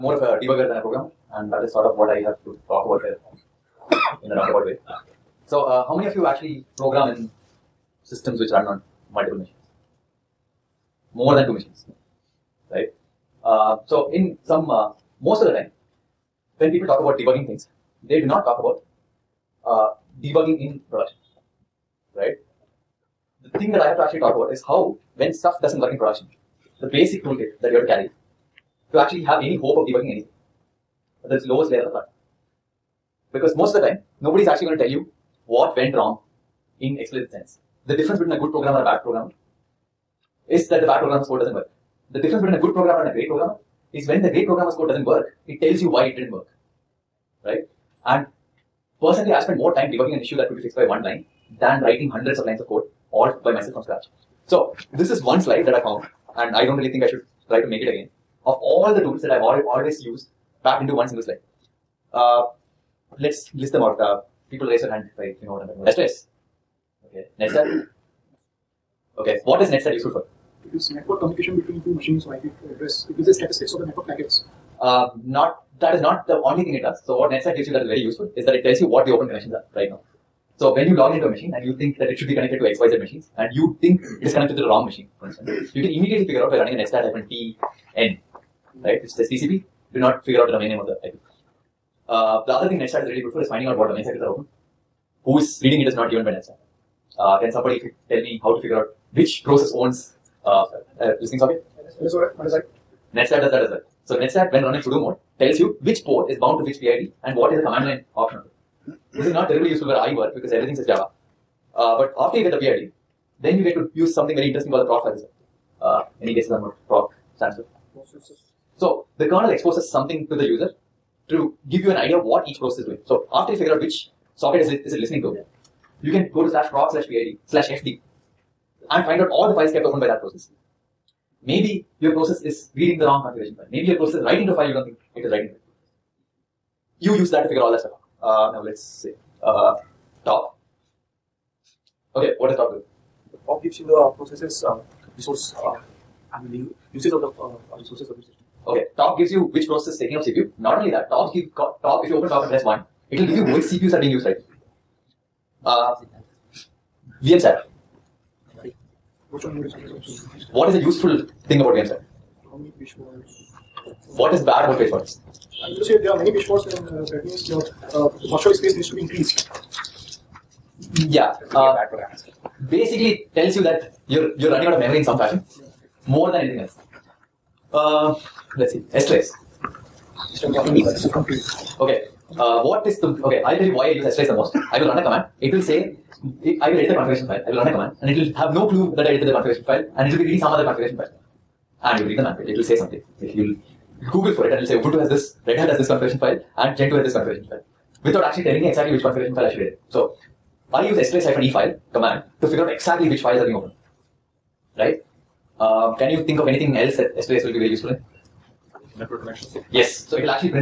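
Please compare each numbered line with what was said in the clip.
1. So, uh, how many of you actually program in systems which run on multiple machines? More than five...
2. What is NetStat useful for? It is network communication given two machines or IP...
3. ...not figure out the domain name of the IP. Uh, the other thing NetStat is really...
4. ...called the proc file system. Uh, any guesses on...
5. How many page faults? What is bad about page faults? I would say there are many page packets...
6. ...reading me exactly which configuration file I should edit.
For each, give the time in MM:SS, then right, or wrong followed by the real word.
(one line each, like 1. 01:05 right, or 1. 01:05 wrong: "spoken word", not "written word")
1. 00:05 wrong: "two", not "five"
2. 01:09 wrong: "between", not "given"
3. 01:29 right
4. 01:54 right
5. 02:42 wrong: "faults", not "packets"
6. 03:18 wrong: "telling", not "reading".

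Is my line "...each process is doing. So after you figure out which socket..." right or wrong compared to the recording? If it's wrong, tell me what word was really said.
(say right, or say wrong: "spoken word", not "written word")
right.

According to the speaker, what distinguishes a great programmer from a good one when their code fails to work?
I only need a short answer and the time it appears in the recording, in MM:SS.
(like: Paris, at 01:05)
It tells you why, at 00:45.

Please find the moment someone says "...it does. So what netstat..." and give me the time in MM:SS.
01:16.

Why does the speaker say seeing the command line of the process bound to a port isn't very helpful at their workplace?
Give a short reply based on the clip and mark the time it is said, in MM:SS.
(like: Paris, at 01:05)
Everything says Java, at 01:50.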